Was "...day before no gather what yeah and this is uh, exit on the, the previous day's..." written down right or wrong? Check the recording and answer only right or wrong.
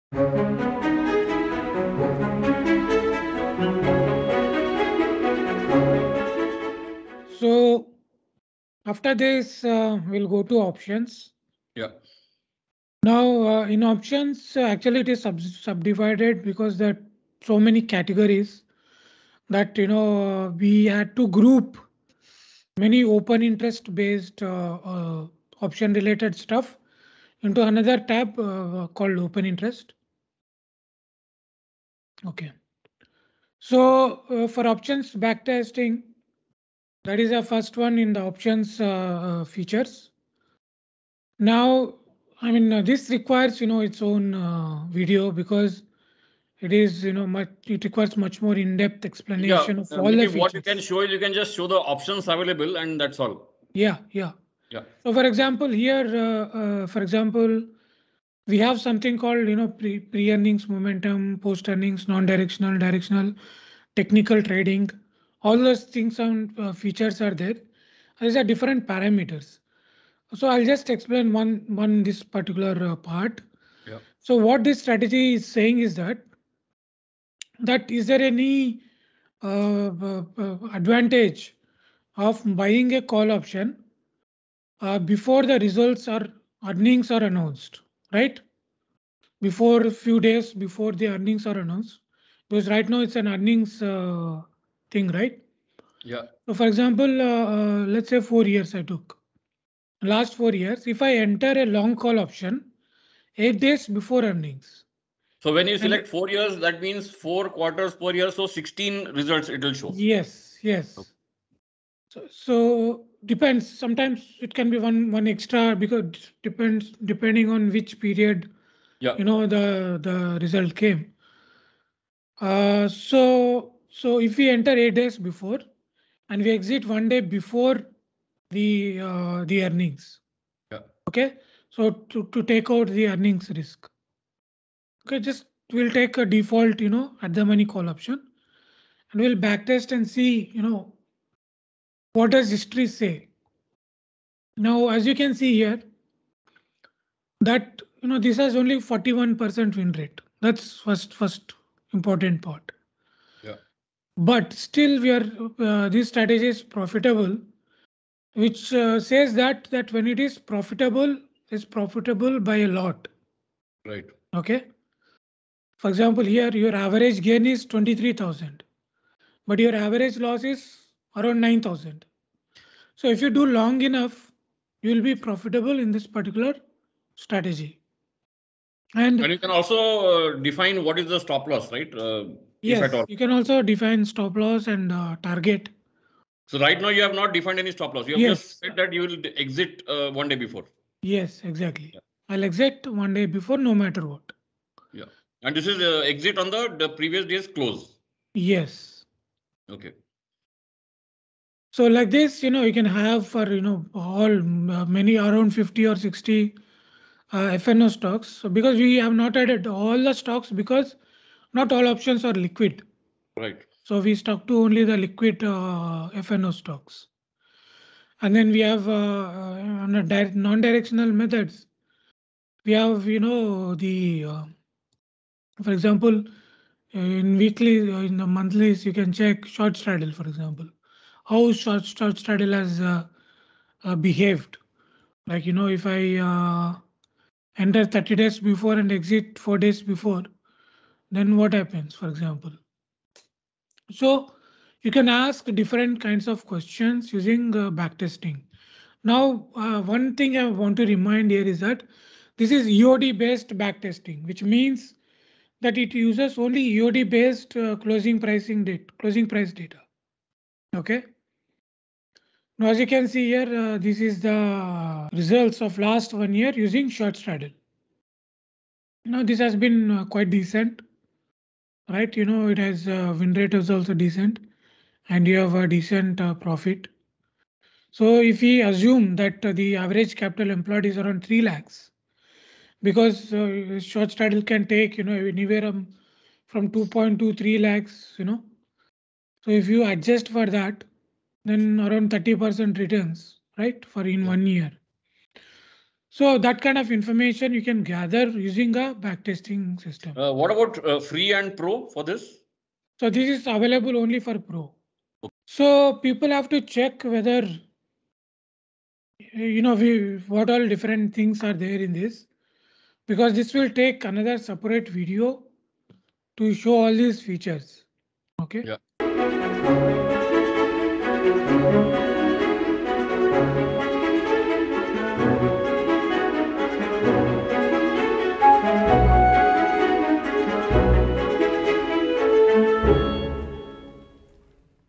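wrong.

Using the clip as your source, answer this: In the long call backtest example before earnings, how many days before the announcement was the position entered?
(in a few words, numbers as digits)
8 days.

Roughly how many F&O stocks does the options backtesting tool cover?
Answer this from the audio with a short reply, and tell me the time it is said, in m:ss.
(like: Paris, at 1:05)
50 or 60, at 3:25.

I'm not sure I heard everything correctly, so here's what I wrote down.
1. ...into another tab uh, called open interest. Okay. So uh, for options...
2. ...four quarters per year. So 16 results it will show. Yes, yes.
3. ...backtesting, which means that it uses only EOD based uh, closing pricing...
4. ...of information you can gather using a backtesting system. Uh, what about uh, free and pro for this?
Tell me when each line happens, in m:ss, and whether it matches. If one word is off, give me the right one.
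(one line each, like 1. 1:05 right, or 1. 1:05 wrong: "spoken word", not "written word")
1. 0:27 right
2. 1:47 right
3. 4:13 right
4. 4:56 right.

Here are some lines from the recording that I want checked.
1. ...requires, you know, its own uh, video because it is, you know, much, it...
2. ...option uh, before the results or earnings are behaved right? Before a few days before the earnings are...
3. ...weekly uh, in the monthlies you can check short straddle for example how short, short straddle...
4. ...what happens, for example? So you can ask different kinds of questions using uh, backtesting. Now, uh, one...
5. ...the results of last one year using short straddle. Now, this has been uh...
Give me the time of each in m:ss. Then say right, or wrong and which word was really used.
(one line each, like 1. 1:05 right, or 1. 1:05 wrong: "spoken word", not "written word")
1. 0:43 right
2. 1:23 wrong: "announced", not "behaved"
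3. 3:47 right
4. 4:01 right
5. 4:24 right.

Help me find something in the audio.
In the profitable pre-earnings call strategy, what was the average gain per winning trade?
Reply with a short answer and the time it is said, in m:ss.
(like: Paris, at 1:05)
23,000, at 2:47.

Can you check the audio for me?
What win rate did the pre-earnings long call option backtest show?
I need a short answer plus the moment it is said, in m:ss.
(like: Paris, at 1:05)
41%, at 2:28.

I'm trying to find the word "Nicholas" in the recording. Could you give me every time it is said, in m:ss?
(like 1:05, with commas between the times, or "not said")
not said.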